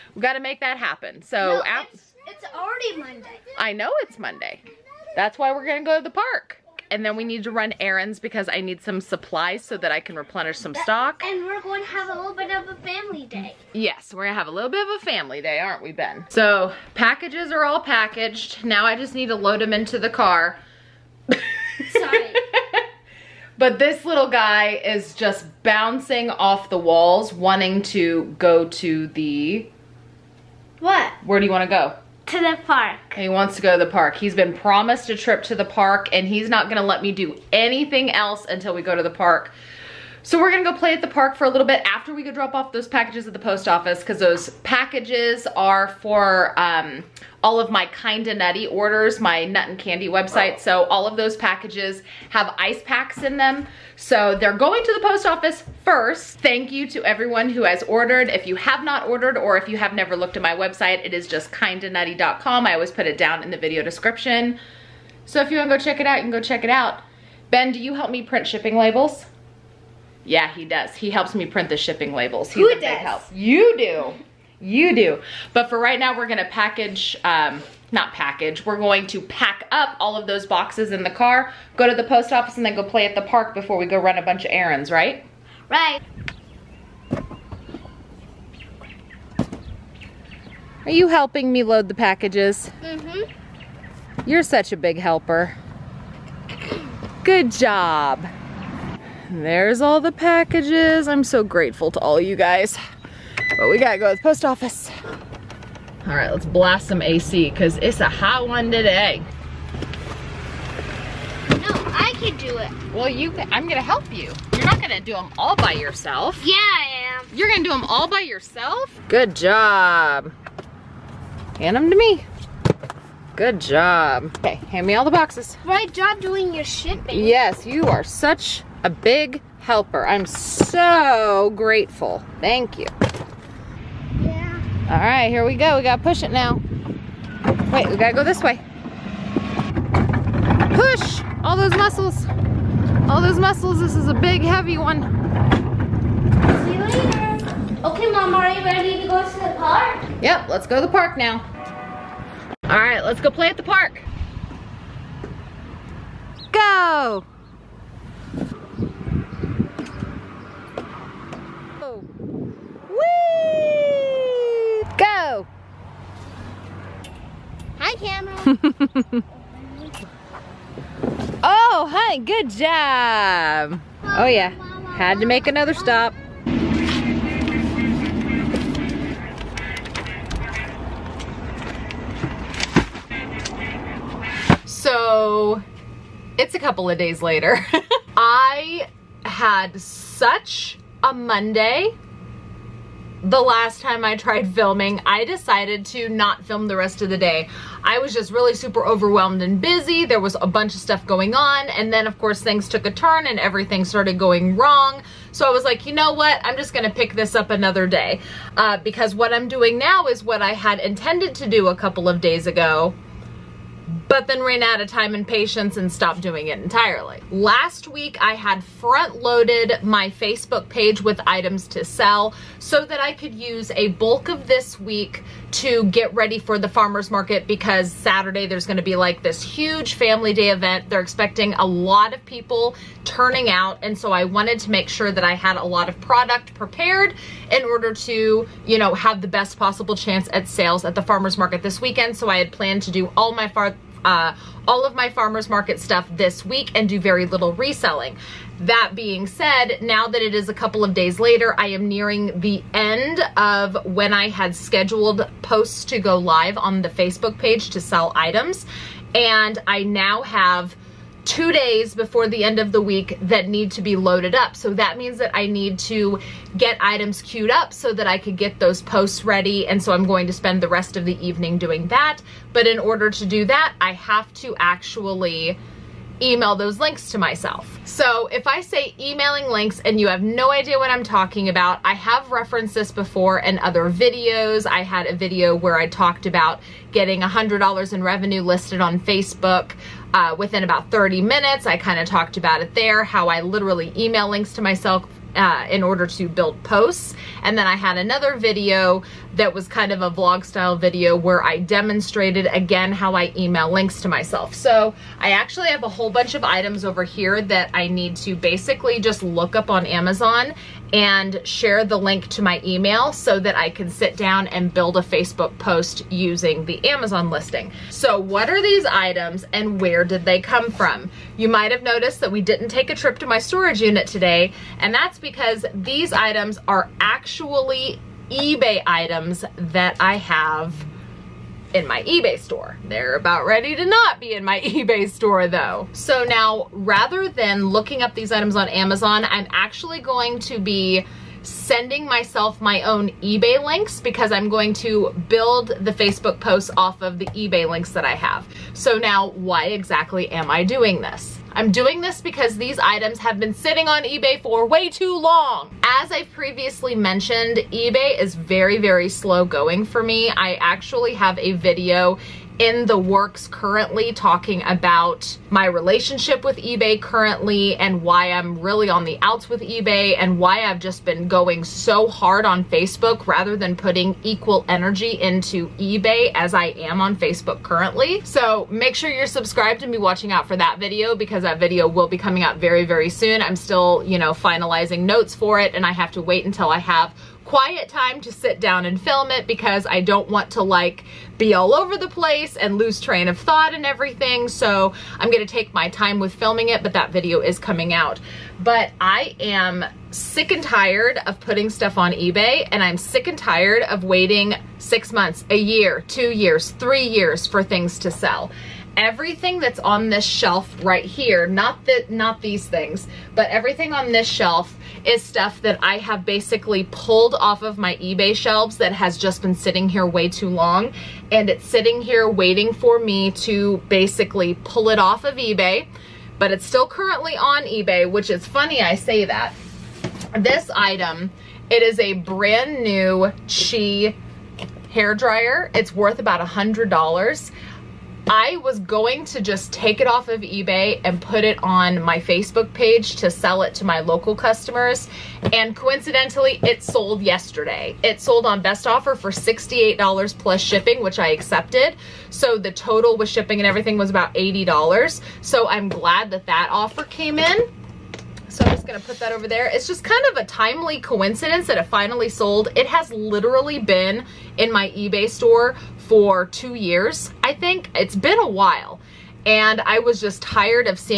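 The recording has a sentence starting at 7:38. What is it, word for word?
So I'm just gonna put that over there.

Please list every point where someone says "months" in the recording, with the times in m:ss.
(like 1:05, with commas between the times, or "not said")
6:45.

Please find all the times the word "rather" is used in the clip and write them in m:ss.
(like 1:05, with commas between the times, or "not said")
5:36, 6:13.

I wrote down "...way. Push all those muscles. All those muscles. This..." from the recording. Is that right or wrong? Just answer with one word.
right.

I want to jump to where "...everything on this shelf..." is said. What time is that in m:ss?
6:53.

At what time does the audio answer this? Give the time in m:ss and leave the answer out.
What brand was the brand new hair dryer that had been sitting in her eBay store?
7:13.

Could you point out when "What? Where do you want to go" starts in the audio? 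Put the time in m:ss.
0:30.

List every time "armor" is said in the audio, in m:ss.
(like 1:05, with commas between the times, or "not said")
not said.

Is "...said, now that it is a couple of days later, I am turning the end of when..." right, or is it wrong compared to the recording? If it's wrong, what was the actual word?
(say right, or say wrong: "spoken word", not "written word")
wrong: "nearing", not "turning".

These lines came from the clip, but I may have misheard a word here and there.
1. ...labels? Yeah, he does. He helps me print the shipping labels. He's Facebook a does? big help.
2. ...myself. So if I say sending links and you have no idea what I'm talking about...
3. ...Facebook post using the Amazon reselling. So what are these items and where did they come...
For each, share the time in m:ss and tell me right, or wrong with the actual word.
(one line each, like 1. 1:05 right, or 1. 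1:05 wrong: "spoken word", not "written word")
1. 1:08 wrong: "Who", not "Facebook"
2. 4:37 wrong: "emailing", not "sending"
3. 5:15 wrong: "listing", not "reselling".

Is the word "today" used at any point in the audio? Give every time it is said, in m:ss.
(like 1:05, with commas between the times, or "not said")
1:48, 5:24.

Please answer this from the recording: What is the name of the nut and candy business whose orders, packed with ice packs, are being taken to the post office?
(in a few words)
Kinda Nutty.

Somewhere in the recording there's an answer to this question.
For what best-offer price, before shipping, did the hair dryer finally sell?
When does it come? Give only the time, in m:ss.
7:29.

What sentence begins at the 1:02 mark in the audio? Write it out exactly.
I always put it down in the video description.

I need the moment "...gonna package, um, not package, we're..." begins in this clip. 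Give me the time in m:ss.
1:16.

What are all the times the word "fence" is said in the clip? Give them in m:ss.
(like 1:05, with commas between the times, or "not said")
not said.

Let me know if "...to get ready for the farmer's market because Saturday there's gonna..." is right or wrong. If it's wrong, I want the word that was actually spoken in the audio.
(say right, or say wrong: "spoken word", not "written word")
right.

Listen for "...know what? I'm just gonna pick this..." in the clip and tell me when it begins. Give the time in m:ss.
3:25.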